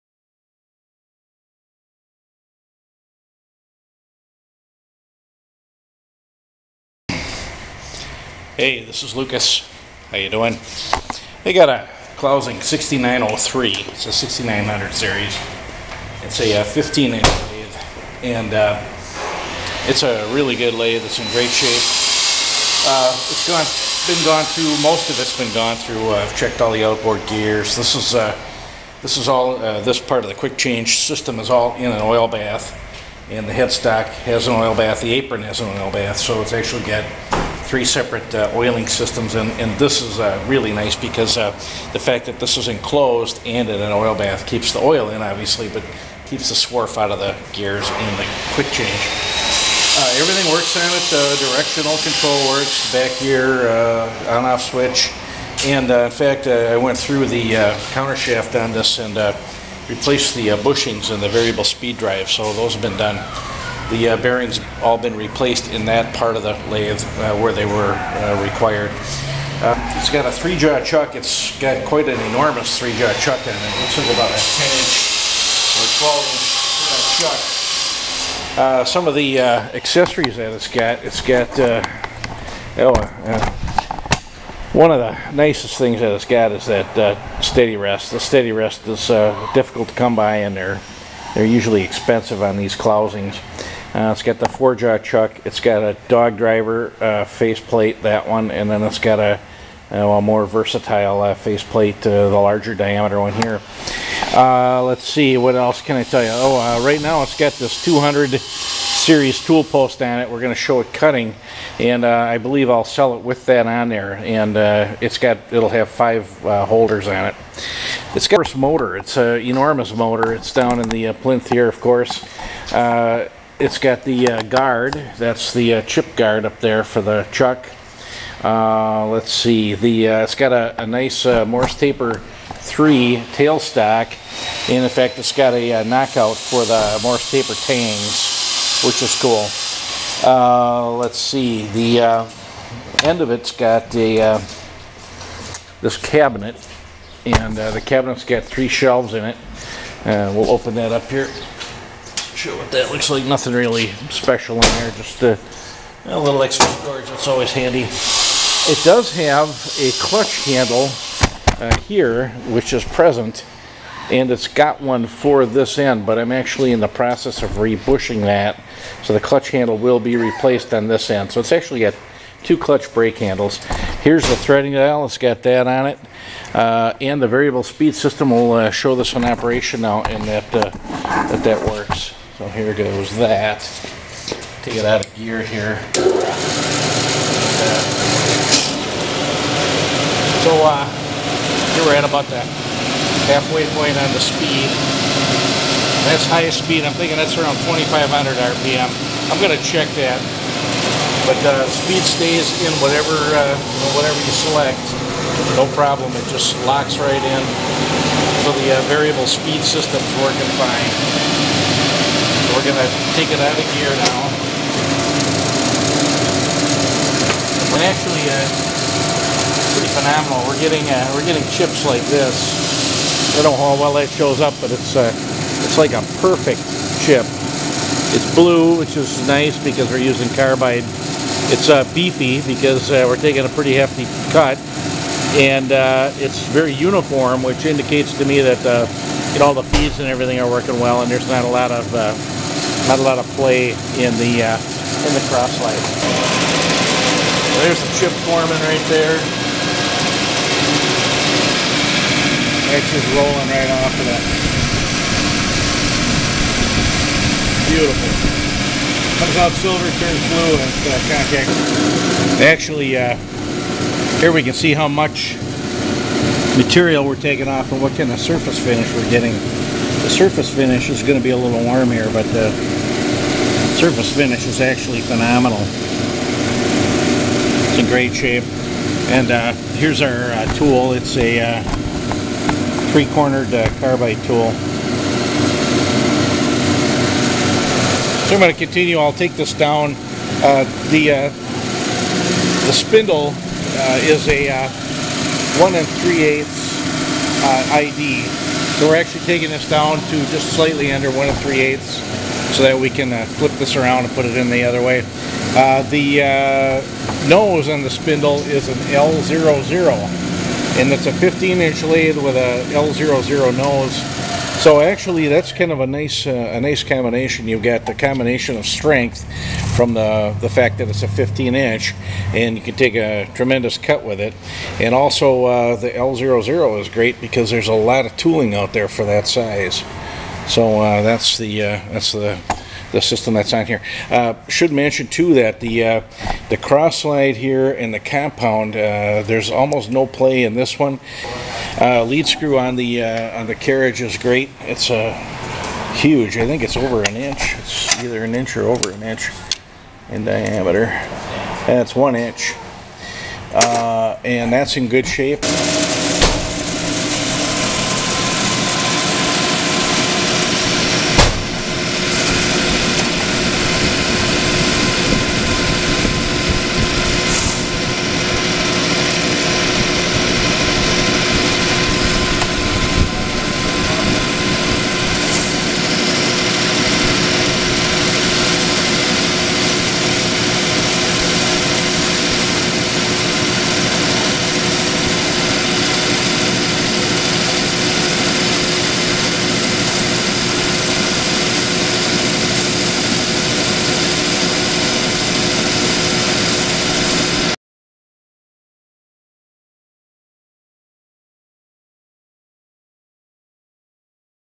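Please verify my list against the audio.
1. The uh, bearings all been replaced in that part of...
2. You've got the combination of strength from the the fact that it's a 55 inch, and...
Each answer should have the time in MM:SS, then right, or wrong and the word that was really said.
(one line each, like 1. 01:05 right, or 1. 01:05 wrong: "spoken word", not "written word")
1. 01:03 right
2. 05:17 wrong: "15", not "55".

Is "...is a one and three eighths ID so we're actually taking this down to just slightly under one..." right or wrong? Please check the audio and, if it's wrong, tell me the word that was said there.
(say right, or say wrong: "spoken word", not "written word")
right.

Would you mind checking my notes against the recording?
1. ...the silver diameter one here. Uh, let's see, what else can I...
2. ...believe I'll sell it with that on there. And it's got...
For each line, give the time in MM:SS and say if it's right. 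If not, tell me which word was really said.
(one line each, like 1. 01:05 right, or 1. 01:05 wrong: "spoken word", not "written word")
1. 01:42 wrong: "larger", not "silver"
2. 01:52 right.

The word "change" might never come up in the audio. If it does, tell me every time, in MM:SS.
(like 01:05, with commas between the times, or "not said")
00:30, 00:48.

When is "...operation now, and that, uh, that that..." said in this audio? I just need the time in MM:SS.
02:59.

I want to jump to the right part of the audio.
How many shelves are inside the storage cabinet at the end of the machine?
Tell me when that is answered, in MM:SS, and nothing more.
02:28.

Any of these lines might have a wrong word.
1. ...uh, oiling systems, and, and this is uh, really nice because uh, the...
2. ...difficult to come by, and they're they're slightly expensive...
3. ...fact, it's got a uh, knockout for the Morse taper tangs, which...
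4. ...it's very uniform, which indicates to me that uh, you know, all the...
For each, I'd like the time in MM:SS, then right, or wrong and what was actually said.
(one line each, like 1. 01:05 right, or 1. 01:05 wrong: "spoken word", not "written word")
1. 00:38 right
2. 01:29 wrong: "usually", not "slightly"
3. 02:14 right
4. 03:56 right.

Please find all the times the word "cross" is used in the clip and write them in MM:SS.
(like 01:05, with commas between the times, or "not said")
04:05, 05:36.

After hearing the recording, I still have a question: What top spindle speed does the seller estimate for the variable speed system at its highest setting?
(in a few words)
2,500 RPM.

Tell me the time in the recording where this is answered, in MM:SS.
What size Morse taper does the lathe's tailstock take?
02:11.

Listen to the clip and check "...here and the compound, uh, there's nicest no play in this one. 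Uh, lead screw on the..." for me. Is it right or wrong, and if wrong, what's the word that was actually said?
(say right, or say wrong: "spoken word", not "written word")
wrong: "almost", not "nicest".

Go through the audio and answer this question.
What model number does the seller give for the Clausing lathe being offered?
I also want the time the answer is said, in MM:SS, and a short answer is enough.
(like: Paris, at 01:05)
6903, at 00:12.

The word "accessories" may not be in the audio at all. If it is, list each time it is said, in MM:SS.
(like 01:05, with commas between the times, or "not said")
01:19.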